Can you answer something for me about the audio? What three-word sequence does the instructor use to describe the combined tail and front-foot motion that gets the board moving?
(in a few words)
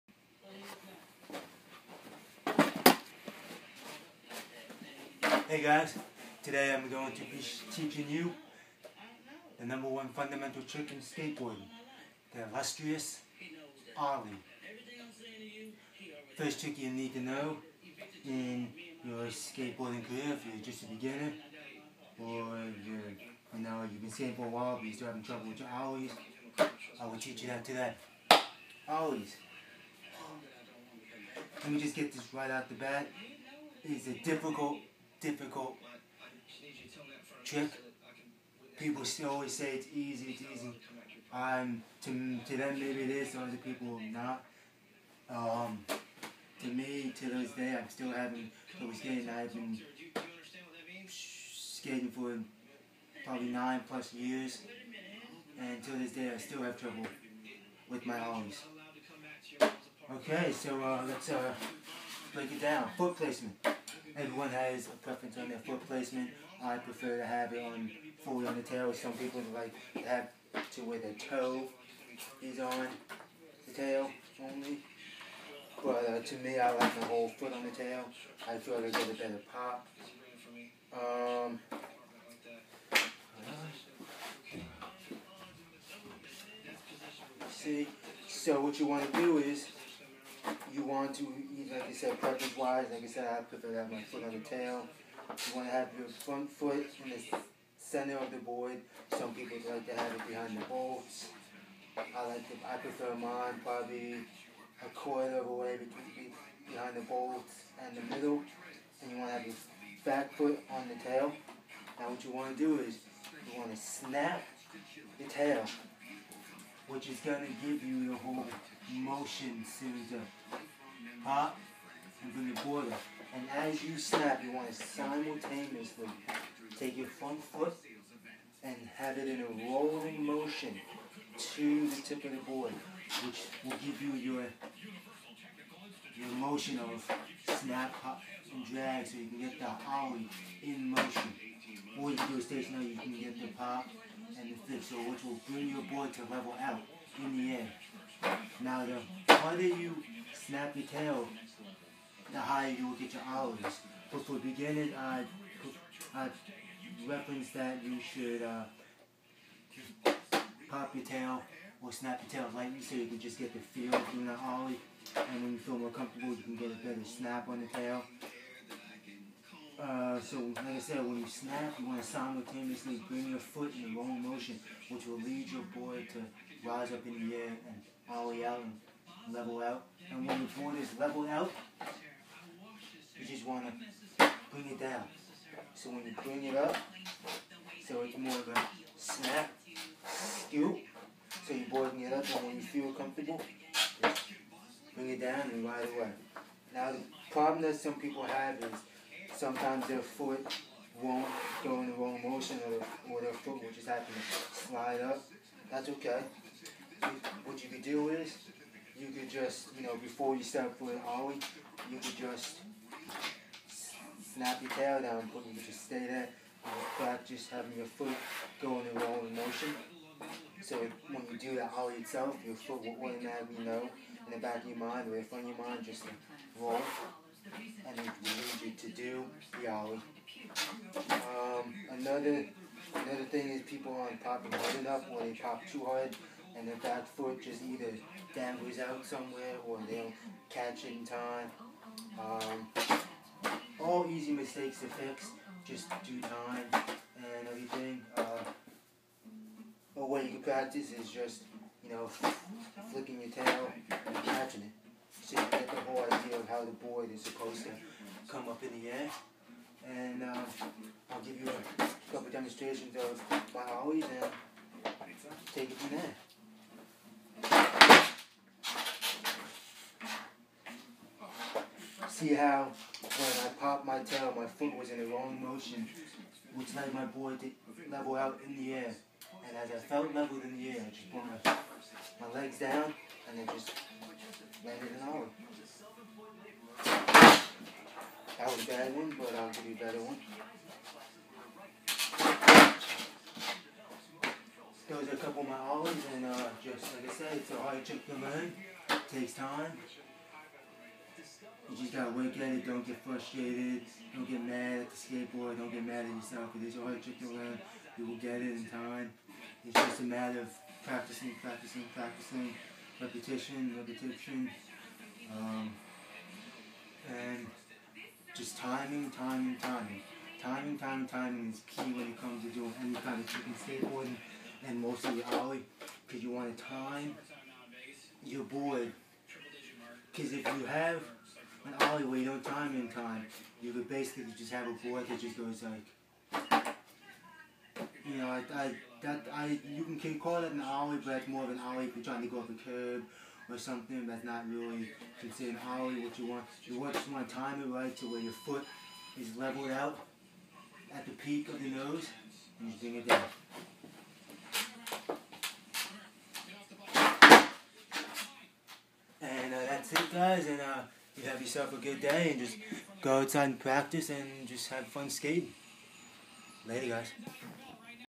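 snap, pop, and drag.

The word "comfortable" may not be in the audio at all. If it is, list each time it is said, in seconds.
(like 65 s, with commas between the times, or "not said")
165 s, 192 s.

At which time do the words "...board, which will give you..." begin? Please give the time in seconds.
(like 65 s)
132 s.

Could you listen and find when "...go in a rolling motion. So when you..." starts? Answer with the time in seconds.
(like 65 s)
218 s.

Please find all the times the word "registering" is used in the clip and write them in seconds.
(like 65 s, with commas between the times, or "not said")
not said.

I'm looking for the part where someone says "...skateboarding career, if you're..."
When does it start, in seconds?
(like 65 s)
19 s.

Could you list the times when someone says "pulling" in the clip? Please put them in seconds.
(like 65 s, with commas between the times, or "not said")
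210 s.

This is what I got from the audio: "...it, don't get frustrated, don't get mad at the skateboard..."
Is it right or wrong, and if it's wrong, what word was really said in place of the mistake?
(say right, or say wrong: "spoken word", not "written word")
right.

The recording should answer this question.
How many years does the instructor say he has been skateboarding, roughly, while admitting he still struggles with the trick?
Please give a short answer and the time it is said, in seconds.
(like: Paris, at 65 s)
9 plus years, at 53 s.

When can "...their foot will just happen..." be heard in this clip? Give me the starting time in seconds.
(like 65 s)
203 s.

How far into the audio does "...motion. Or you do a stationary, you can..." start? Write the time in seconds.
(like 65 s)
140 s.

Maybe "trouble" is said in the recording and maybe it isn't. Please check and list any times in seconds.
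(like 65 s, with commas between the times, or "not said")
25 s, 48 s, 56 s.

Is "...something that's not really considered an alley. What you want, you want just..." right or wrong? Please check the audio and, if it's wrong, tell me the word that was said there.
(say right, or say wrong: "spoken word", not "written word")
right.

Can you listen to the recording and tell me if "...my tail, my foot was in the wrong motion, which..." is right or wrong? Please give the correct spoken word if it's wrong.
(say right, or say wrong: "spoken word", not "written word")
right.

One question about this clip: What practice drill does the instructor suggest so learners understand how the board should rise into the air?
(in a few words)
flicking your tail and catching it.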